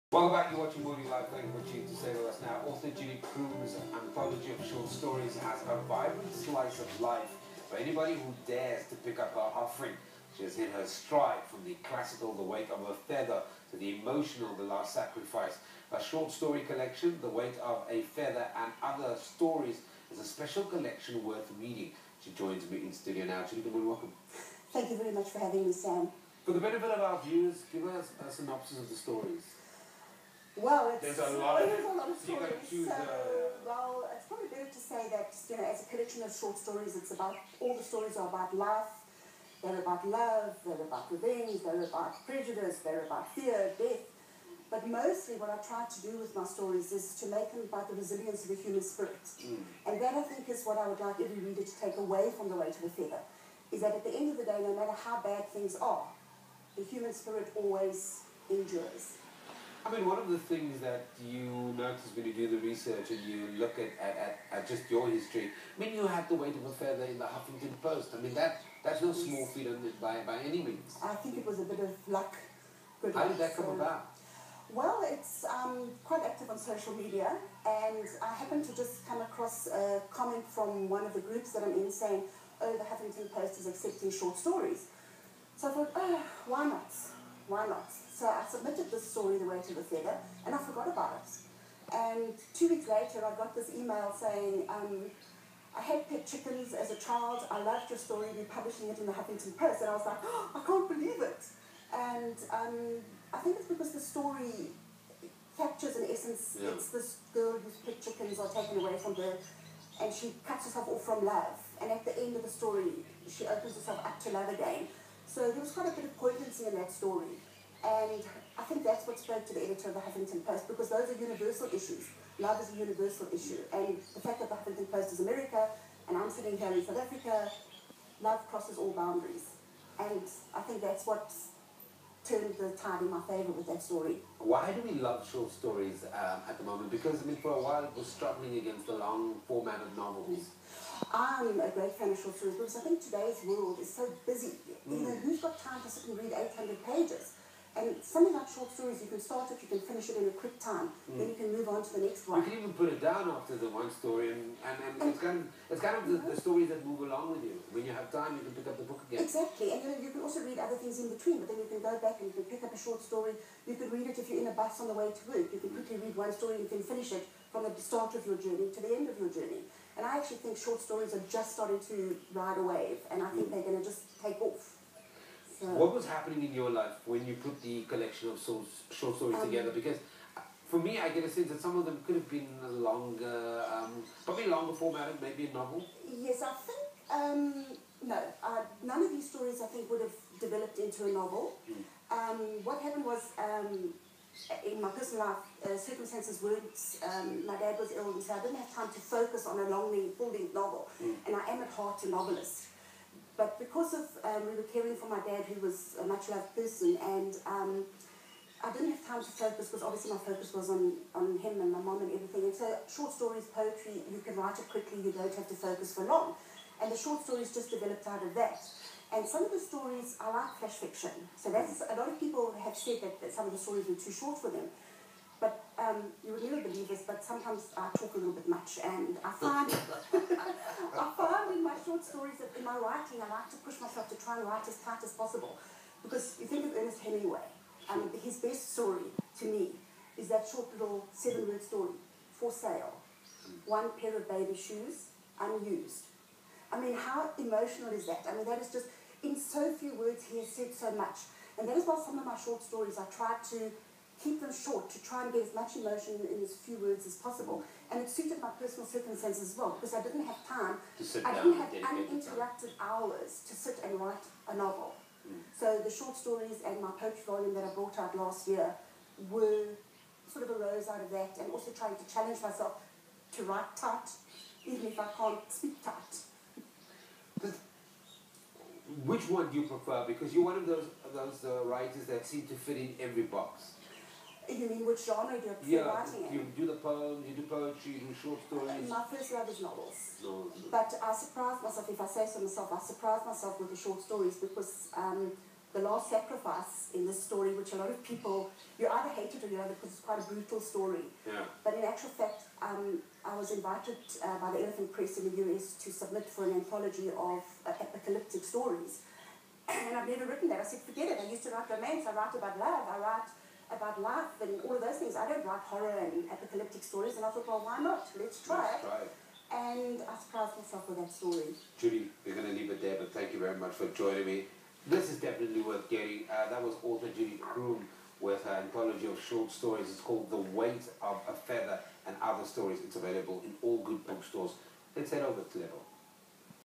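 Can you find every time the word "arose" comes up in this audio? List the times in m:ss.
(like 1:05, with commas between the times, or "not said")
4:30.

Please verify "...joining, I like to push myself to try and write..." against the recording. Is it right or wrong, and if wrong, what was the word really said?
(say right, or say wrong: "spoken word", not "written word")
wrong: "writing", not "joining".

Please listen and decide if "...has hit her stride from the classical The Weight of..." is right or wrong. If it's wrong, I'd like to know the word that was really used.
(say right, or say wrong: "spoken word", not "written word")
right.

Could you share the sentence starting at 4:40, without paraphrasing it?
Because you're one of those of those uh, writers that seem to fit in every box.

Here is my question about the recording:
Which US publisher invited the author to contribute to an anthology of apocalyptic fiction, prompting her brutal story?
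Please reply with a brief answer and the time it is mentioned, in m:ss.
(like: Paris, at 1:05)
Elephant Press, at 5:04.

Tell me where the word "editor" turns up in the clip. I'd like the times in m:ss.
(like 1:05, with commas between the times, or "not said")
1:59.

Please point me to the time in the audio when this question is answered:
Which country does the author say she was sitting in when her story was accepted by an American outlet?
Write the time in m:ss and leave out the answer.
2:06.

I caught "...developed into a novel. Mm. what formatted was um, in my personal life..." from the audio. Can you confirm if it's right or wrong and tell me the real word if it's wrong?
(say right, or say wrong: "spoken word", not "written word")
wrong: "happened", not "formatted".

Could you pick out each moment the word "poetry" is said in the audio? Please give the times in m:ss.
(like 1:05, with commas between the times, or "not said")
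3:33, 4:26, 4:47.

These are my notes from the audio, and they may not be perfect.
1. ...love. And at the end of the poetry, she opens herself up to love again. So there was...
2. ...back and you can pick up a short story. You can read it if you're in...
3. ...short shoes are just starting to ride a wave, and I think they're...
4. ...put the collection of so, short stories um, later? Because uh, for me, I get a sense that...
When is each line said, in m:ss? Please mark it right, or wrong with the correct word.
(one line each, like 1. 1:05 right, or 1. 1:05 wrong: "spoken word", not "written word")
1. 1:51 wrong: "story", not "poetry"
2. 2:41 right
3. 2:50 wrong: "stories", not "shoes"
4. 2:57 wrong: "together", not "later".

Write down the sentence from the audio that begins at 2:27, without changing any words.
And something like short stories, you can start it, you can finish it in a quick time, mm.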